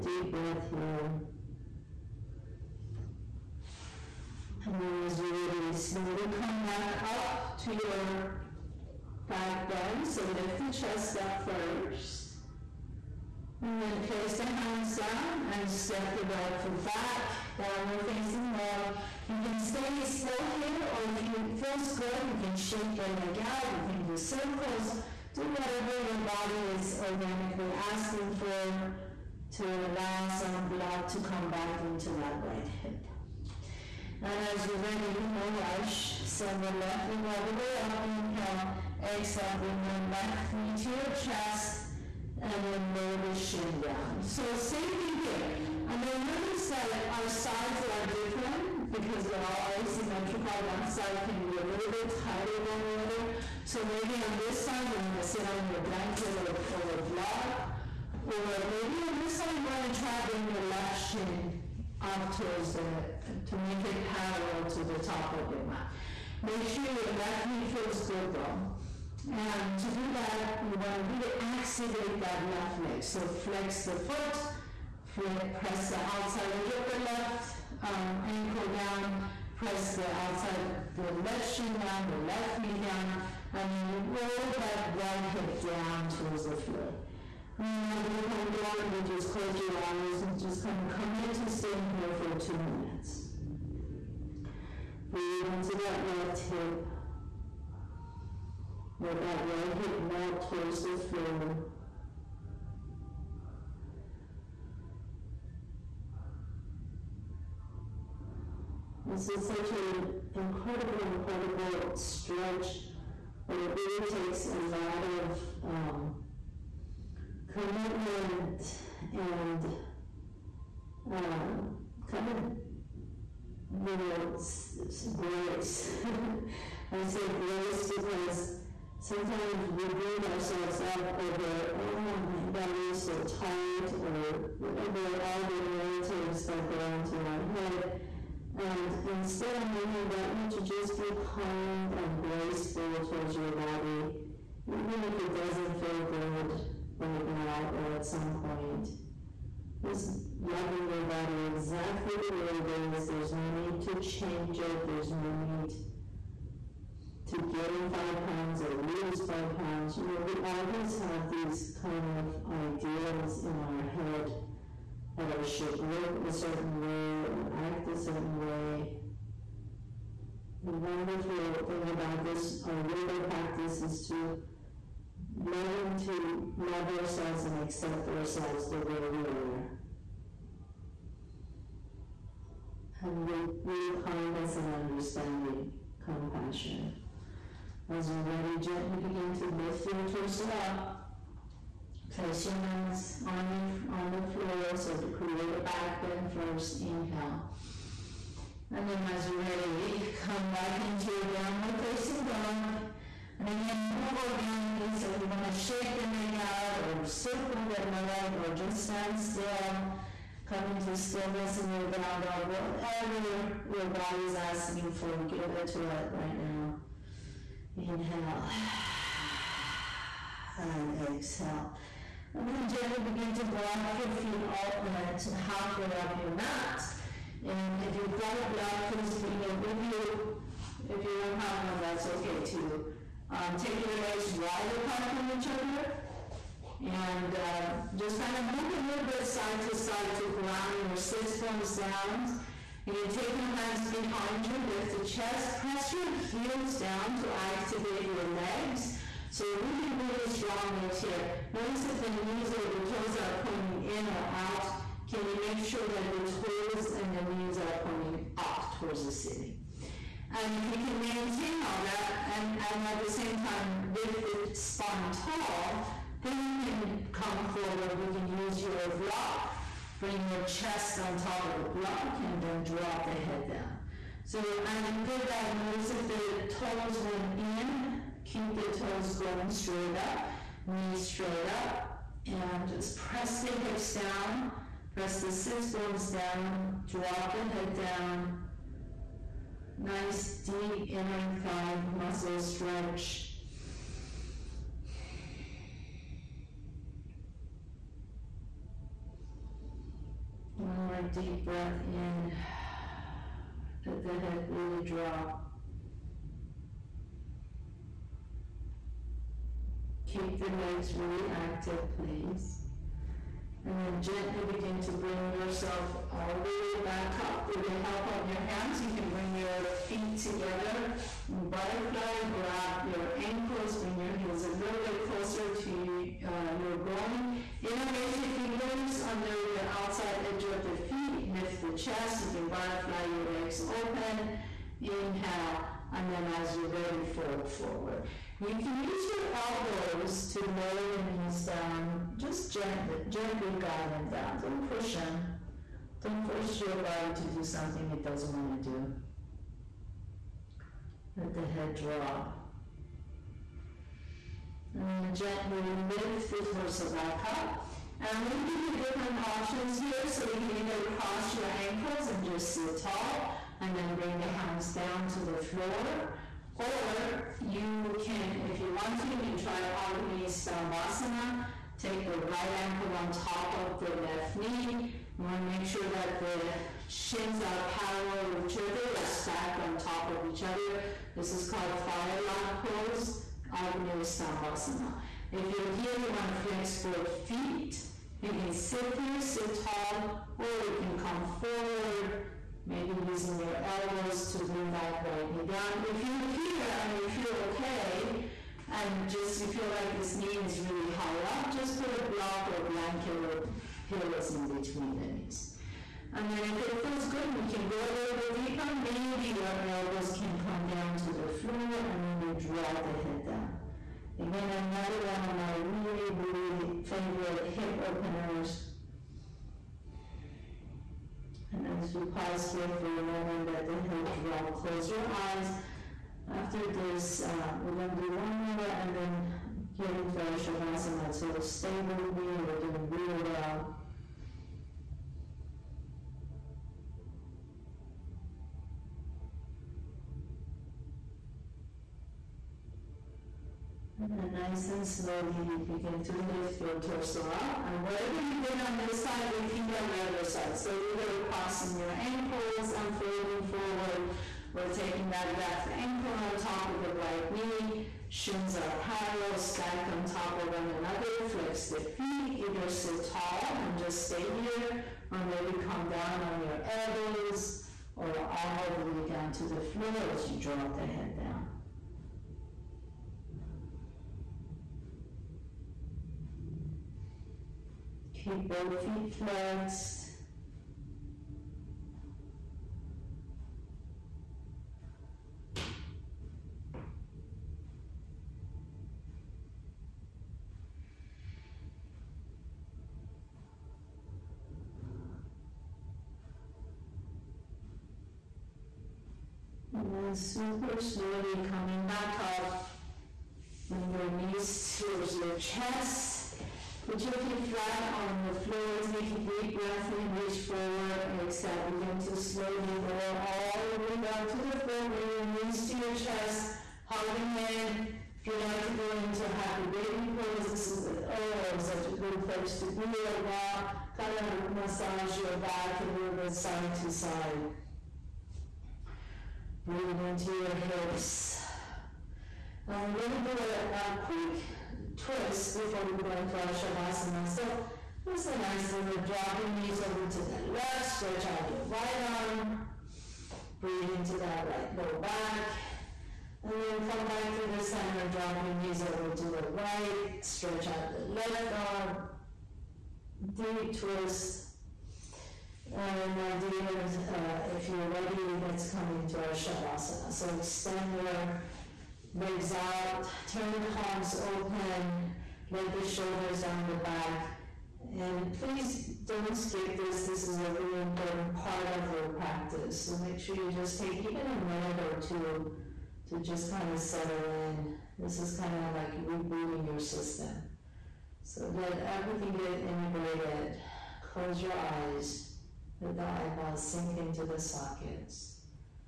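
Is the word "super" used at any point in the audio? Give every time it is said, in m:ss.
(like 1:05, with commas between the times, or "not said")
8:20.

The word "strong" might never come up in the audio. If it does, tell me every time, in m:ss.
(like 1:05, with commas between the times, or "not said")
4:10.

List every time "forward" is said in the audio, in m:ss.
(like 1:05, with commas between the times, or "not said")
4:27, 5:37, 6:31, 7:33, 8:30.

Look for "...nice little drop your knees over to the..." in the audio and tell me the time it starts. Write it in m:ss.
8:58.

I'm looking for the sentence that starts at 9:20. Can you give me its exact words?
So extend your legs out, turn the palms open, let the shoulders down the back.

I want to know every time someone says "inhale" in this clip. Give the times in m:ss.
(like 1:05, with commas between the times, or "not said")
0:38, 3:16, 3:37, 5:34.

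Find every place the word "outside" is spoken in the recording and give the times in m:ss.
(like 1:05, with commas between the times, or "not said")
1:15, 1:20, 5:29.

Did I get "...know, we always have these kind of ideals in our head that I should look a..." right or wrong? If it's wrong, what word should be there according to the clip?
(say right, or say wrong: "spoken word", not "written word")
right.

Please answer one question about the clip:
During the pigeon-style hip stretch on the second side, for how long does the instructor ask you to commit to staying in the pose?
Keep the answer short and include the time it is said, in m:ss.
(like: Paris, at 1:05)
2 minutes, at 1:32.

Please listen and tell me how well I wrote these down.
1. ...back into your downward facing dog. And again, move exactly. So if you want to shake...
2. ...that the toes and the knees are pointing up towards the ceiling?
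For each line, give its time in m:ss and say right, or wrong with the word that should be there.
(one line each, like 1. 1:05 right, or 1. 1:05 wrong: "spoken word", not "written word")
1. 3:20 wrong: "organically", not "exactly"
2. 4:15 right.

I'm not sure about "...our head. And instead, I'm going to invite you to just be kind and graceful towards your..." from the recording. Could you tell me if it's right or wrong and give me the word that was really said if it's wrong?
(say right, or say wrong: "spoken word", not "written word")
right.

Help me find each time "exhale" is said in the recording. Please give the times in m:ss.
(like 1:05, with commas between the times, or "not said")
0:39, 3:41, 8:31.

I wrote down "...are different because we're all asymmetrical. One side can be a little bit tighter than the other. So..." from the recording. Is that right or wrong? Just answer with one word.
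right.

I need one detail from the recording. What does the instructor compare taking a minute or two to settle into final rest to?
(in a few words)
Rebooting.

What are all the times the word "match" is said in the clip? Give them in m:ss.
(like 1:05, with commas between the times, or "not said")
not said.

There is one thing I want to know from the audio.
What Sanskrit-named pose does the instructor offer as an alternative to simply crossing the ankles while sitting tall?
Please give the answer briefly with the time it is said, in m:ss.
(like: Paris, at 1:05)
Agni Stambhasana, at 6:09.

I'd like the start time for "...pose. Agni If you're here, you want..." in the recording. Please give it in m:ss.
6:22.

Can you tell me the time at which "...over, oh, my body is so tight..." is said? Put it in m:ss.
2:11.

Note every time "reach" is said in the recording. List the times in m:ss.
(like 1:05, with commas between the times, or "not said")
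8:30.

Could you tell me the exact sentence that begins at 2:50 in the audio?
The wonderful thing about this, our yoga practice is to learning to love ourselves and accept ourselves the way we are.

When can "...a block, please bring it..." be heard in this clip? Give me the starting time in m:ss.
3:48.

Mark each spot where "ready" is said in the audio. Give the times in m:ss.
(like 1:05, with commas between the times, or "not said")
0:34, 3:08, 3:19, 5:36, 9:17.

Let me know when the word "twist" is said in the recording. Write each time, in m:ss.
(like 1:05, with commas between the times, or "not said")
8:55, 9:13.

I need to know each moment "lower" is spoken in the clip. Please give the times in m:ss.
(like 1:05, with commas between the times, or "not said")
0:42, 5:40, 8:32.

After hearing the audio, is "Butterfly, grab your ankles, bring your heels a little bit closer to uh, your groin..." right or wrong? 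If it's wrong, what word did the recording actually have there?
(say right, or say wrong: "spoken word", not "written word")
right.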